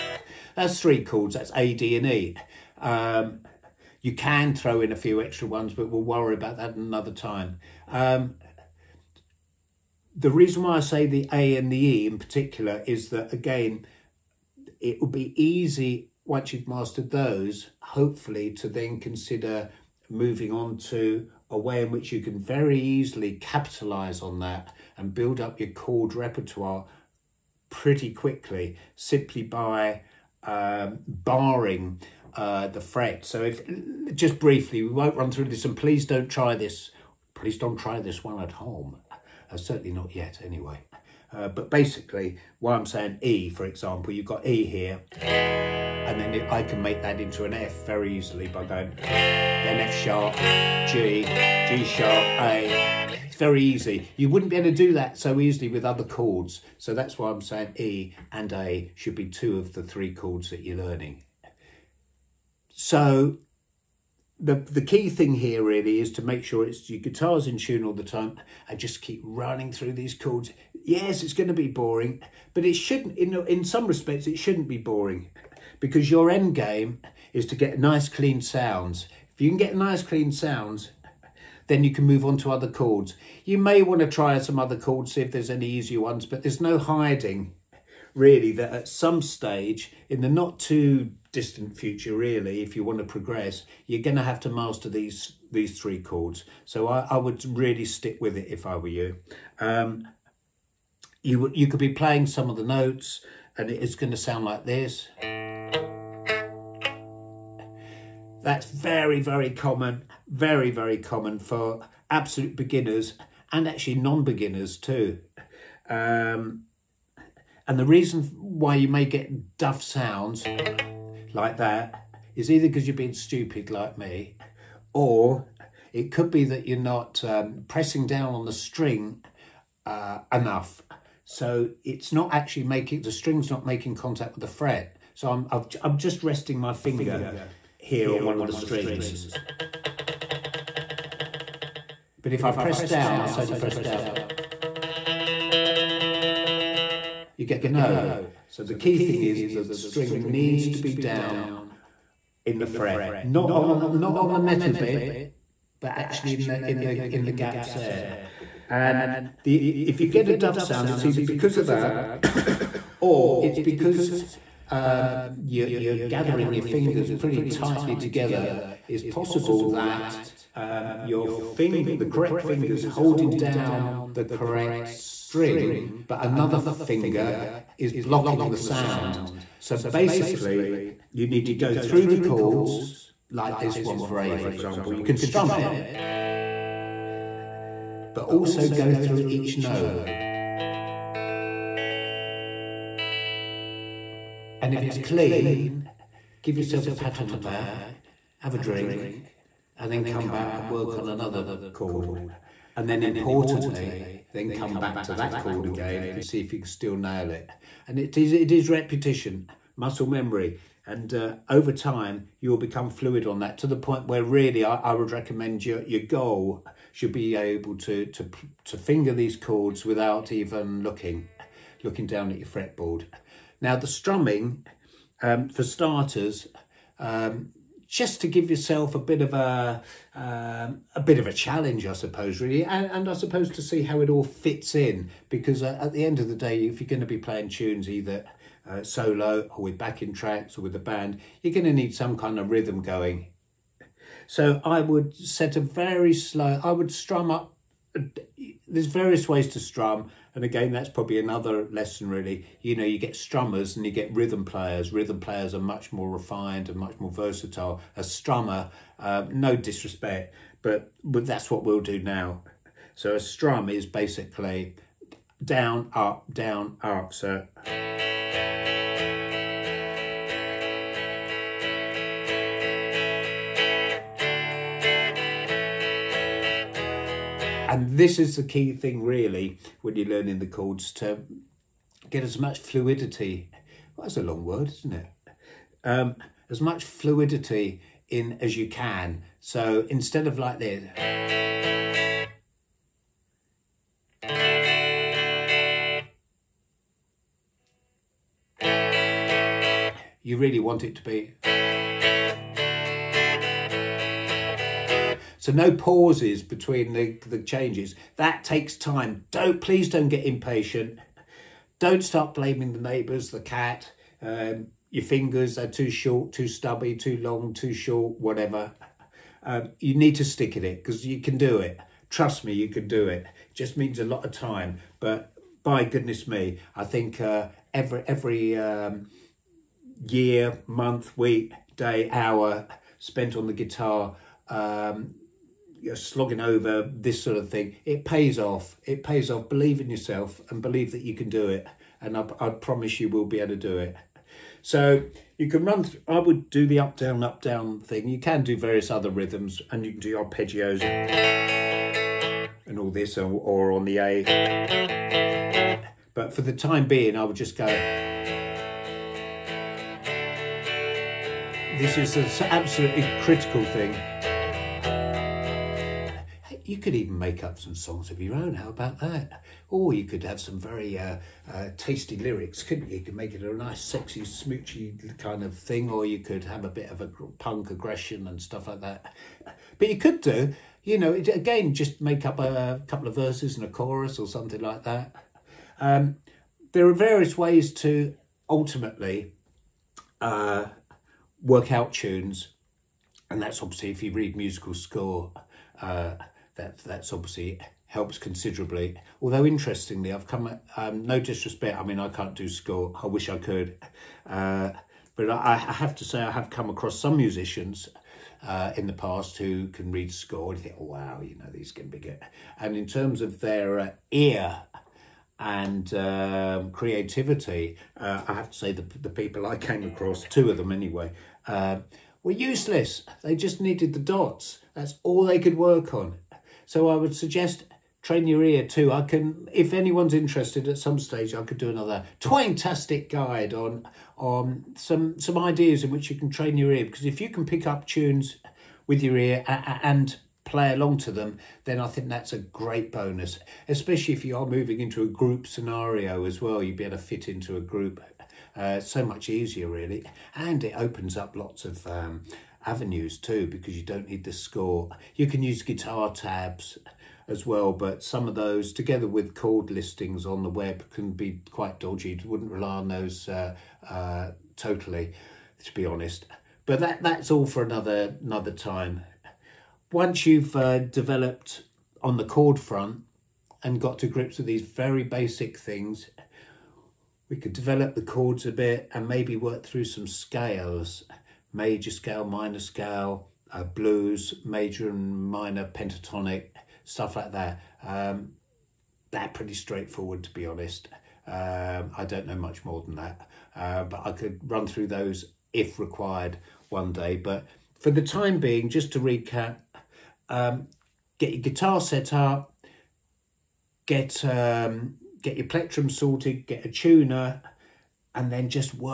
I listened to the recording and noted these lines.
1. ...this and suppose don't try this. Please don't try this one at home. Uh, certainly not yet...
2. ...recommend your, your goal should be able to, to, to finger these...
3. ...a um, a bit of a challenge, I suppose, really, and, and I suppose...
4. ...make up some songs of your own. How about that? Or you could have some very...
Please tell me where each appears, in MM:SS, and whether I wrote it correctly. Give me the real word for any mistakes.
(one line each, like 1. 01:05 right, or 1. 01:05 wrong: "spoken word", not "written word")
1. 00:35 wrong: "please", not "suppose"
2. 03:35 right
3. 03:49 right
4. 06:07 right.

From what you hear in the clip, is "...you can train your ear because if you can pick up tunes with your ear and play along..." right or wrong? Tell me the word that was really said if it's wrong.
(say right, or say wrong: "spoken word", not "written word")
right.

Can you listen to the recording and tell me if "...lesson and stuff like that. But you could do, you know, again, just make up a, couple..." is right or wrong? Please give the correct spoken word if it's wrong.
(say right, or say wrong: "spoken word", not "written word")
wrong: "aggression", not "lesson".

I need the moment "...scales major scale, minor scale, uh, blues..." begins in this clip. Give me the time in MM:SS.
08:00.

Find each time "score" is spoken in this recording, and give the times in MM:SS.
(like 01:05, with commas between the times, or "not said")
06:34, 06:42, 06:50, 07:34.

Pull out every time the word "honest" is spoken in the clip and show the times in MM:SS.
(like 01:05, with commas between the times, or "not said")
07:45, 08:10.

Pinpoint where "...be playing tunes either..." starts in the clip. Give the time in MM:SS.
03:57.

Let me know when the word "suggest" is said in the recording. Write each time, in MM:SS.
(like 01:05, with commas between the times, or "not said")
07:07.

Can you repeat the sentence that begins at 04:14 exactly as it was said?
Rhythm players are much more refined and much more versatile.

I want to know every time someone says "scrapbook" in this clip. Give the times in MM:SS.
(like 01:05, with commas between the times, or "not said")
not said.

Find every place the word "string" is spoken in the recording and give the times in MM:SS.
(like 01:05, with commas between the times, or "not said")
02:08, 02:13, 02:18, 02:29, 02:54.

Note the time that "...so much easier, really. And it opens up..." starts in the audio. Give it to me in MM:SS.
07:28.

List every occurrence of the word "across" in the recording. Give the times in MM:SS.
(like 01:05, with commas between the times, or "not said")
06:46, 06:59.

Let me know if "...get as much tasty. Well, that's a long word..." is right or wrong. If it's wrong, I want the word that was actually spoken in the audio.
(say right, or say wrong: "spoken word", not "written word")
wrong: "fluidity", not "tasty".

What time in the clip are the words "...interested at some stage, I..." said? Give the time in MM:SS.
07:10.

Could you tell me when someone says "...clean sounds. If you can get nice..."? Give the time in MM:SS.
01:18.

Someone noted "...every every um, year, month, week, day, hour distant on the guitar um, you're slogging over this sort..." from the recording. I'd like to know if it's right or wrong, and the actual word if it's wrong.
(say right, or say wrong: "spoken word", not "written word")
wrong: "spent", not "distant".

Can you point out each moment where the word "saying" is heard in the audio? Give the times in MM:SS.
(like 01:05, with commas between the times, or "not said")
00:42, 00:57.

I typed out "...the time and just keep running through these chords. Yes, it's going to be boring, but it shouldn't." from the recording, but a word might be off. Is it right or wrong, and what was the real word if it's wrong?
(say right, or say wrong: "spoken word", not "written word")
right.